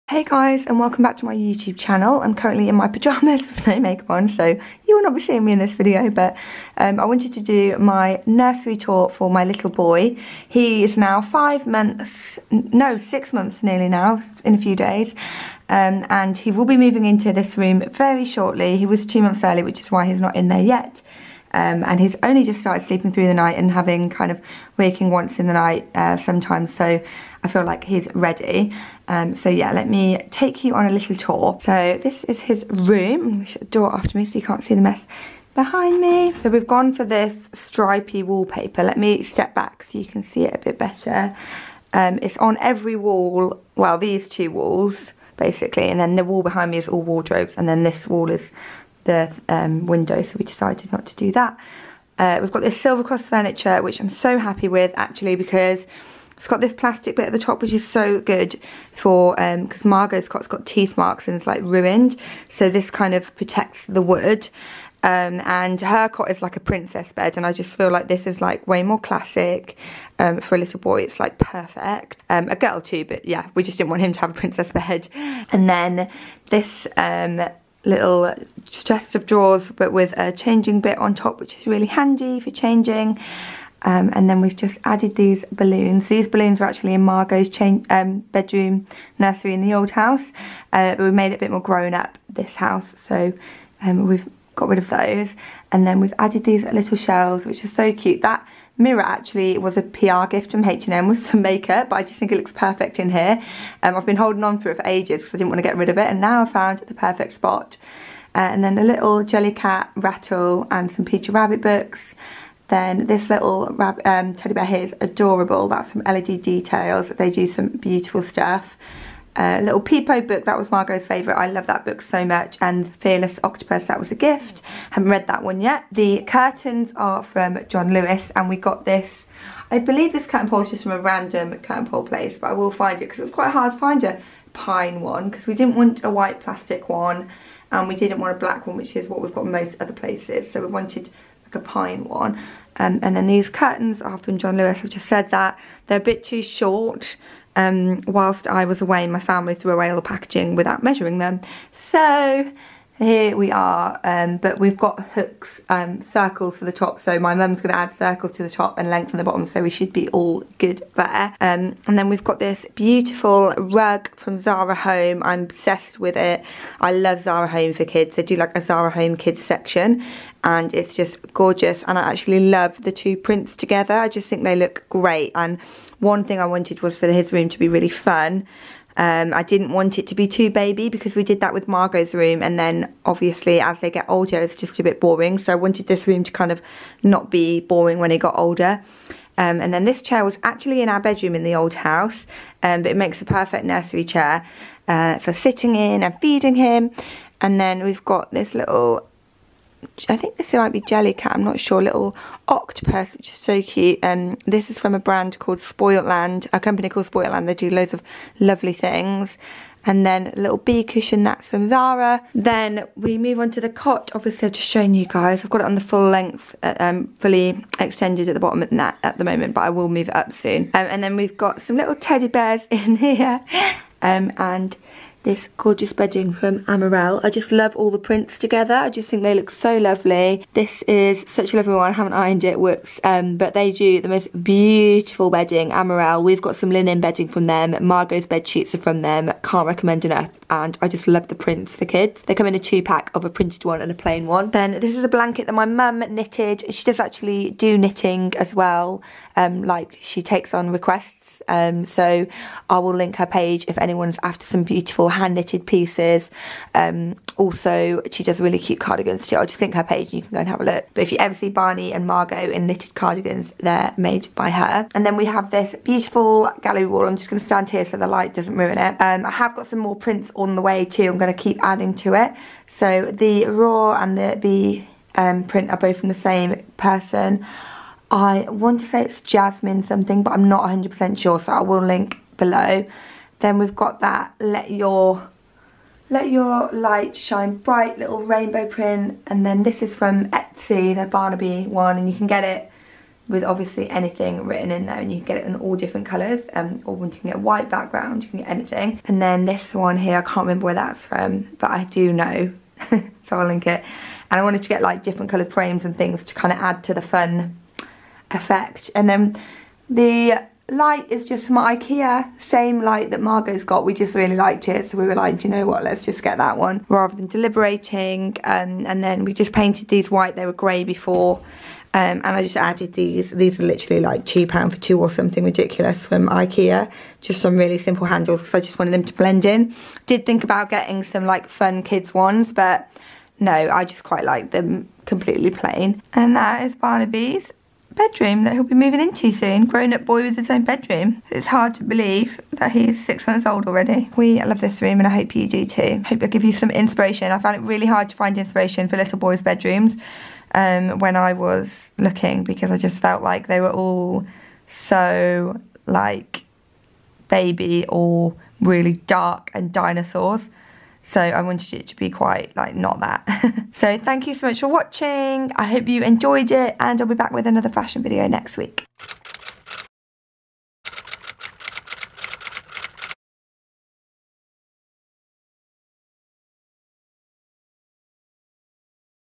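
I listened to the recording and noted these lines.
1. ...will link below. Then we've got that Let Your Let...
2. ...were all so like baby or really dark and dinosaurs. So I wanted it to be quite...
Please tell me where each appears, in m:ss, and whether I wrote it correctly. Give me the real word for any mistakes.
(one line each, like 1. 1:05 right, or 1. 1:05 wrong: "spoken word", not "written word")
1. 4:41 right
2. 5:53 right.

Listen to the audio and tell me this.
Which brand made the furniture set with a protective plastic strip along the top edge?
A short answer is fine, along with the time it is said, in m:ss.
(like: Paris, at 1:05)
Silver Cross, at 0:52.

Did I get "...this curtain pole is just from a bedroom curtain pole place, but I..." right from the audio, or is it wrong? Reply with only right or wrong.
wrong.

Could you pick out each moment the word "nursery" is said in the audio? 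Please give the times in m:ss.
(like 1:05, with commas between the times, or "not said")
0:08, 1:29, 3:13.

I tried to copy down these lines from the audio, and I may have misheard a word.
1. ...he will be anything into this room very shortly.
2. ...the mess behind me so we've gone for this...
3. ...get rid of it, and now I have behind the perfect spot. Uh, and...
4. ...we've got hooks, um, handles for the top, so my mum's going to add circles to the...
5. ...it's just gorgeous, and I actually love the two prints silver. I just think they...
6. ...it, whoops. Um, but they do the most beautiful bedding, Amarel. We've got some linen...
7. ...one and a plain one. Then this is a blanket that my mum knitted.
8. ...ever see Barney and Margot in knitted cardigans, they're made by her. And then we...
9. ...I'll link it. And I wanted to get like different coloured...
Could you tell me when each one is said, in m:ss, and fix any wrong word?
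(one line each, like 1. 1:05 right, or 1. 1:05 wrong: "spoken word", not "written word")
1. 0:16 wrong: "moving", not "anything"
2. 0:34 right
3. 1:45 wrong: "found", not "behind"
4. 2:34 wrong: "circles", not "handles"
5. 2:50 wrong: "together", not "silver"
6. 3:52 right
7. 4:03 right
8. 4:21 right
9. 5:03 right.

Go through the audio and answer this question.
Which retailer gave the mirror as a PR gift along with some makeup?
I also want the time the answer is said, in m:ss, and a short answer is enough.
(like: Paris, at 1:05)
H&M, at 1:40.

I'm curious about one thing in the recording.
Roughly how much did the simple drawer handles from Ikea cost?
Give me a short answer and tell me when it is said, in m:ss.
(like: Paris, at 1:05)
£2 for two, at 5:24.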